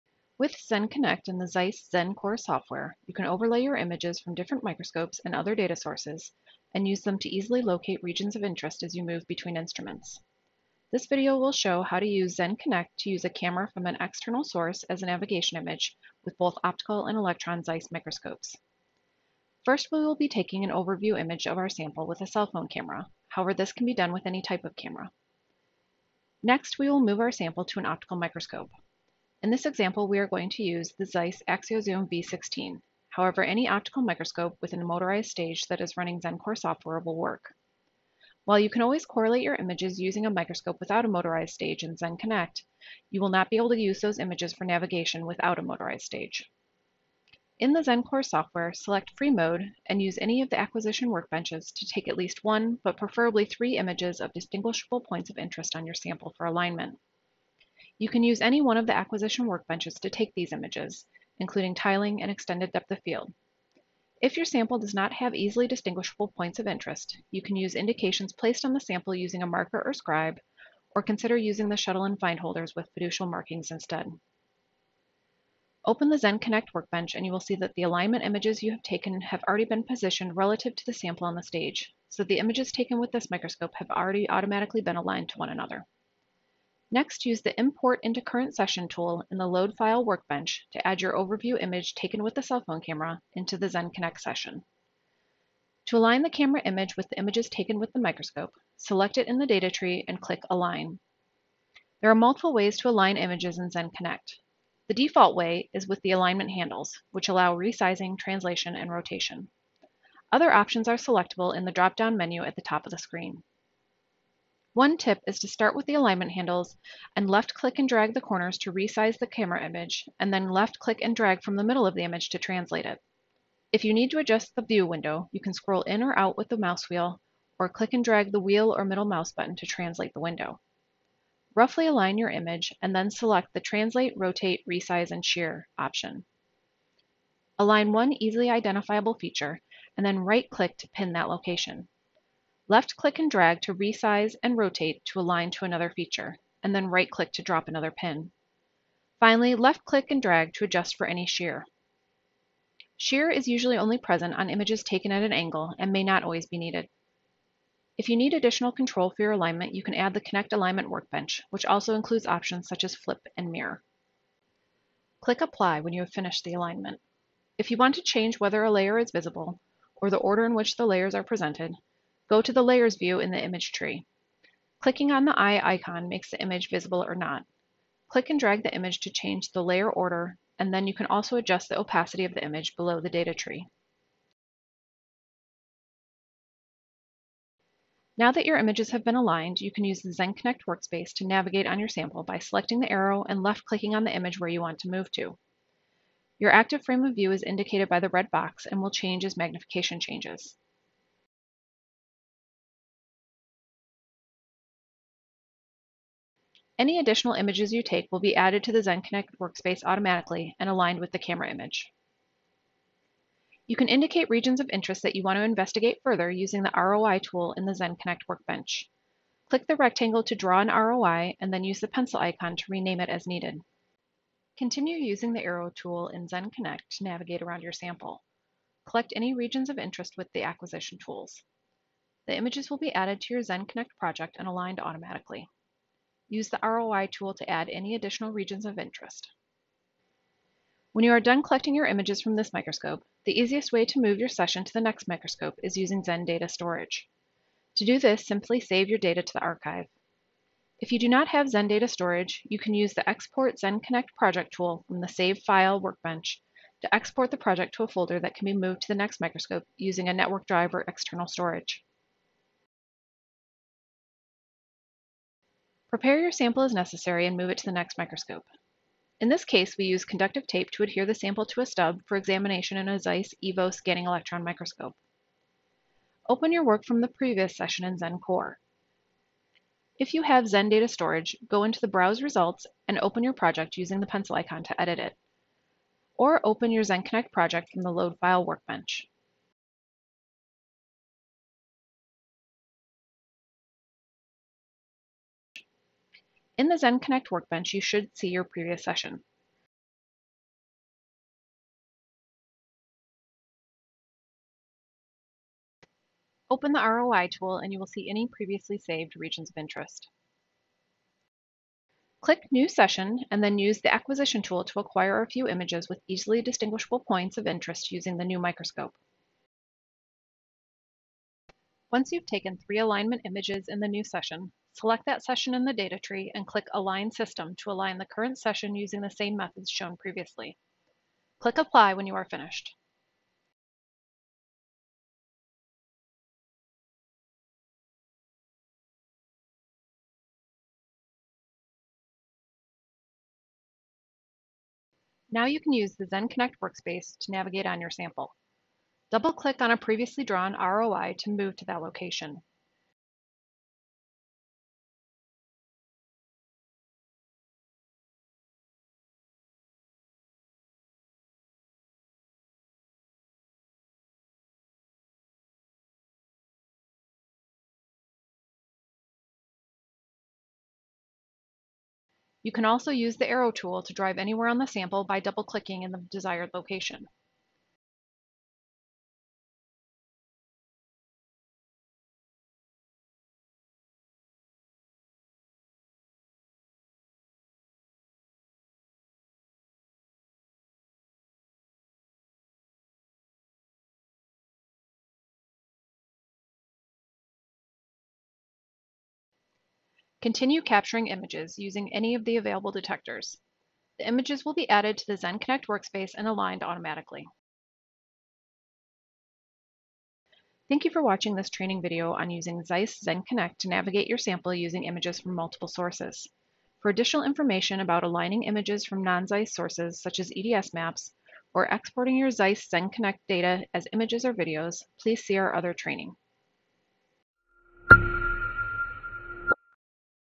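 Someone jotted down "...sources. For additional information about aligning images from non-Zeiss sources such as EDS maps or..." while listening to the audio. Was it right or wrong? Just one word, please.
right.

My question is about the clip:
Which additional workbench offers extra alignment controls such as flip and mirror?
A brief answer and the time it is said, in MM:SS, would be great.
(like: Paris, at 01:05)
Connect Alignment Workbench, at 02:40.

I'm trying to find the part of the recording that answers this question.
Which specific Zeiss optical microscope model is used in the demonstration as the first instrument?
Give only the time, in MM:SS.
00:31.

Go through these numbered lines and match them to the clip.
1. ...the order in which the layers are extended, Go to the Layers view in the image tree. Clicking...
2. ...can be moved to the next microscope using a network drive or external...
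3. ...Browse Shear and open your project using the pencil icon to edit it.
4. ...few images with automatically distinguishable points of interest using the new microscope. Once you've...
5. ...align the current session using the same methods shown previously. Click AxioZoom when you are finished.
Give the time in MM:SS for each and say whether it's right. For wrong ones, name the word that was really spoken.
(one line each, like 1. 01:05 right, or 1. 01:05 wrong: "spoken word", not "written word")
1. 02:50 wrong: "presented", not "extended"
2. 04:18 right
3. 04:41 wrong: "Results", not "Shear"
4. 05:15 wrong: "easily", not "automatically"
5. 05:27 wrong: "Apply", not "AxioZoom".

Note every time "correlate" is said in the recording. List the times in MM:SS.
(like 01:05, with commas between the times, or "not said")
00:39.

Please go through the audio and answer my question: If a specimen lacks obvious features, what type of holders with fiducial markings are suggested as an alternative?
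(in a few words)
Shuttle and find holders.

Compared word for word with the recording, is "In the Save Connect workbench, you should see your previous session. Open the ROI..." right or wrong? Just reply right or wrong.
wrong.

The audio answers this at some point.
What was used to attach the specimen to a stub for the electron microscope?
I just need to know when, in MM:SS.
04:30.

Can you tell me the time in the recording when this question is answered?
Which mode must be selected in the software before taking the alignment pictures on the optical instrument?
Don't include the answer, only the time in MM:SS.
00:49.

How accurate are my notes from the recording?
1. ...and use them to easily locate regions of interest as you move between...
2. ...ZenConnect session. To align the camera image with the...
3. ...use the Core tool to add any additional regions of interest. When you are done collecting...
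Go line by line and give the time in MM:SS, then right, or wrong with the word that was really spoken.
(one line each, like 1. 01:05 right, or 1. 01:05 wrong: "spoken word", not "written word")
1. 00:06 right
2. 01:33 right
3. 03:56 wrong: "ROI", not "Core".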